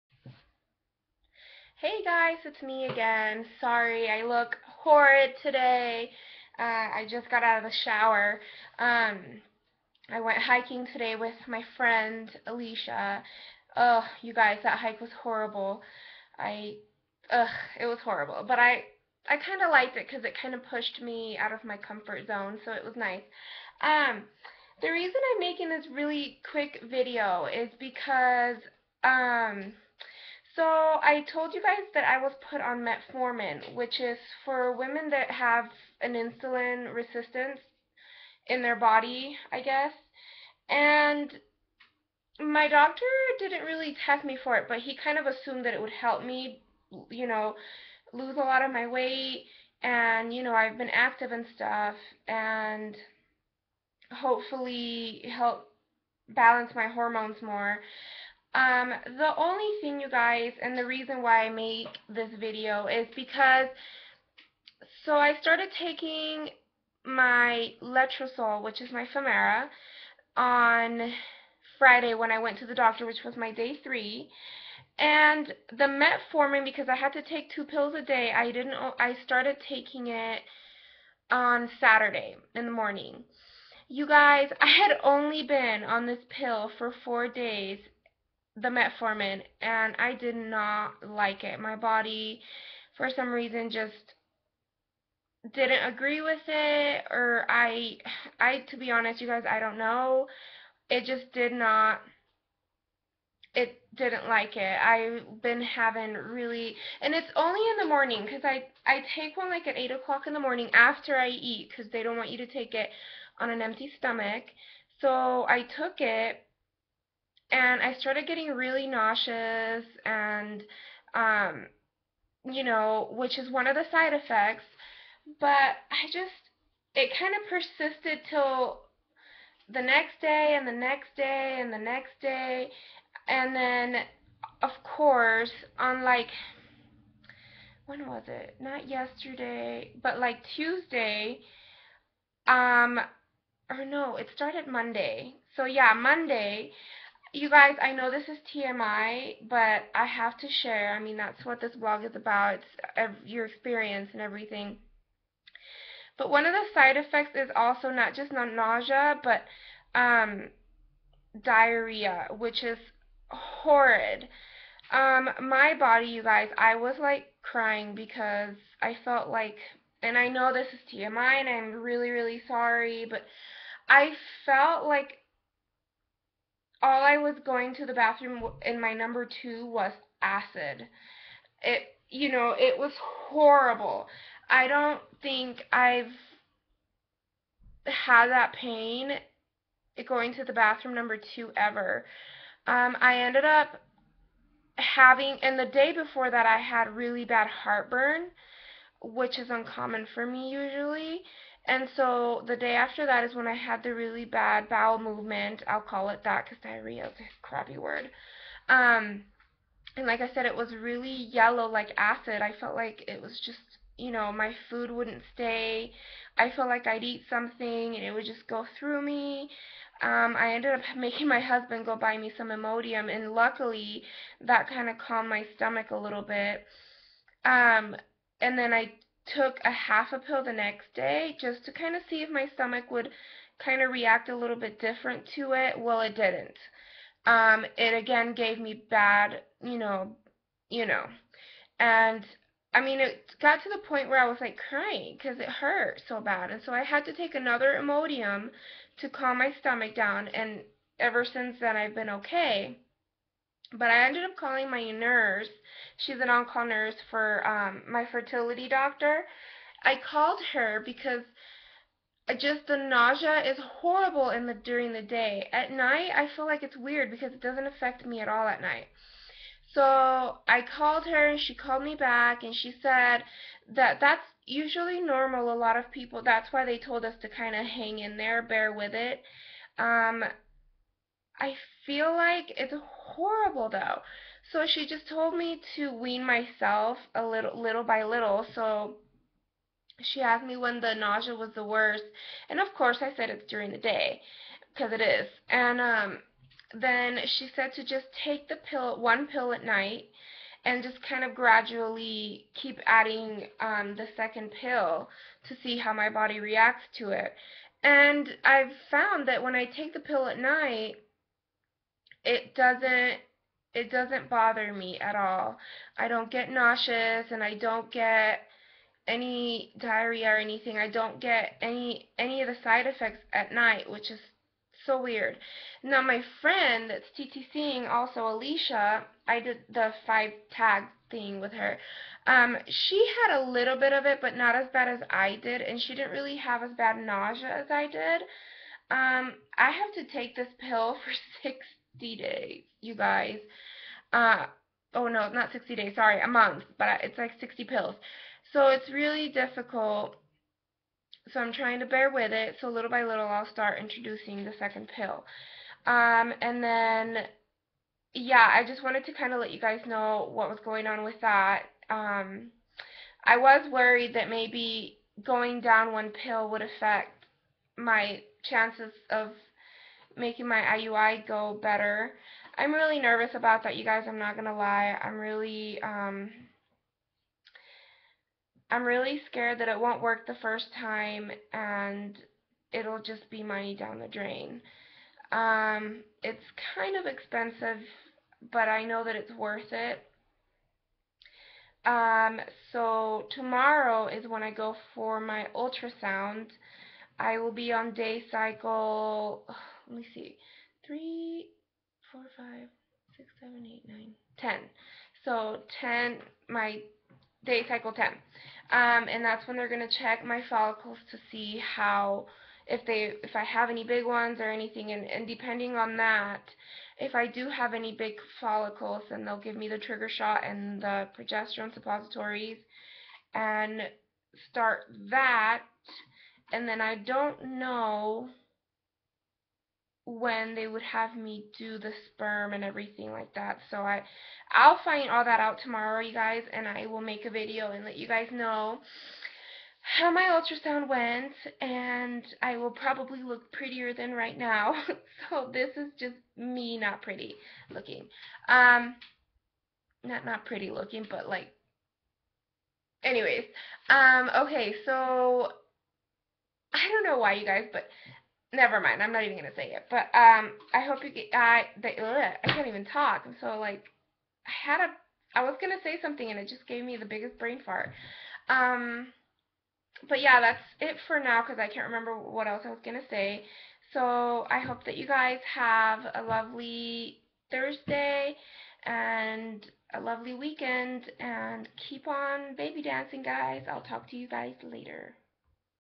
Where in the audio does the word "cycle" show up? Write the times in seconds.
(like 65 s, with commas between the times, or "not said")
398 s, 407 s.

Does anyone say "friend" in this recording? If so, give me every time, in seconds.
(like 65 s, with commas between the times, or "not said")
11 s, 326 s.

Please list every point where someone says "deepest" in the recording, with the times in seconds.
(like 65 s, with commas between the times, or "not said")
not said.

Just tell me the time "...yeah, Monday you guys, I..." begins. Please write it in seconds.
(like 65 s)
145 s.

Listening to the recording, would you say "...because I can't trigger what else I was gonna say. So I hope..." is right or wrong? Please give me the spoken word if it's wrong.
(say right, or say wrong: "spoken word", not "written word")
wrong: "remember", not "trigger".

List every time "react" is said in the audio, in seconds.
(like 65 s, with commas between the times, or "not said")
233 s, 306 s.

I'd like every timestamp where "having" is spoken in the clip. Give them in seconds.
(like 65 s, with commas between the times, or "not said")
105 s, 194 s.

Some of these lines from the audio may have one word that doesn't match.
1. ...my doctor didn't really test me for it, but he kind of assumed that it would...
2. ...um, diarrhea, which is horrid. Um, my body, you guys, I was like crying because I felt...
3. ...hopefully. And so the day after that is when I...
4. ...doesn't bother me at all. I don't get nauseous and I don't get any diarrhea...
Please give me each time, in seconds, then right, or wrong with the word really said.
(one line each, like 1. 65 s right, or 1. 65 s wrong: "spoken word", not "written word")
1. 42 s right
2. 159 s right
3. 200 s wrong: "usually", not "hopefully"
4. 313 s right.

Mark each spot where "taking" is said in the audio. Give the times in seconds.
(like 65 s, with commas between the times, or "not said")
65 s, 79 s.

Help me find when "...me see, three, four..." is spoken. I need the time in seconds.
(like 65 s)
400 s.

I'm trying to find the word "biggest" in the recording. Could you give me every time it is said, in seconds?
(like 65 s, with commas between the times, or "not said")
467 s.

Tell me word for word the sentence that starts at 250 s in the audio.
And ever since then, I've been okay.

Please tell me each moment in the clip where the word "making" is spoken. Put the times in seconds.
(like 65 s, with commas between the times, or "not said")
25 s, 220 s, 370 s.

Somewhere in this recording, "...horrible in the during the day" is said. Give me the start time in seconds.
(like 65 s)
263 s.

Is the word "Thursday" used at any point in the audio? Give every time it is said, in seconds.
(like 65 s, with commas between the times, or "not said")
477 s.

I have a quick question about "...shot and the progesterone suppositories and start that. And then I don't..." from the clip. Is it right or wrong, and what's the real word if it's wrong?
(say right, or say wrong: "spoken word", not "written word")
right.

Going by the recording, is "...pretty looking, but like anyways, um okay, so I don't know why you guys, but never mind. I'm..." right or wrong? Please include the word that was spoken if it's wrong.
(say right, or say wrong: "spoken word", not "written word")
right.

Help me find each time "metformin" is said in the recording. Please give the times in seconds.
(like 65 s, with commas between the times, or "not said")
32 s, 75 s, 88 s.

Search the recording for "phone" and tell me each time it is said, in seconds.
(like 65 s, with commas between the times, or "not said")
not said.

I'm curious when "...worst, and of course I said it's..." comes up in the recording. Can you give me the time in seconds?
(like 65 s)
291 s.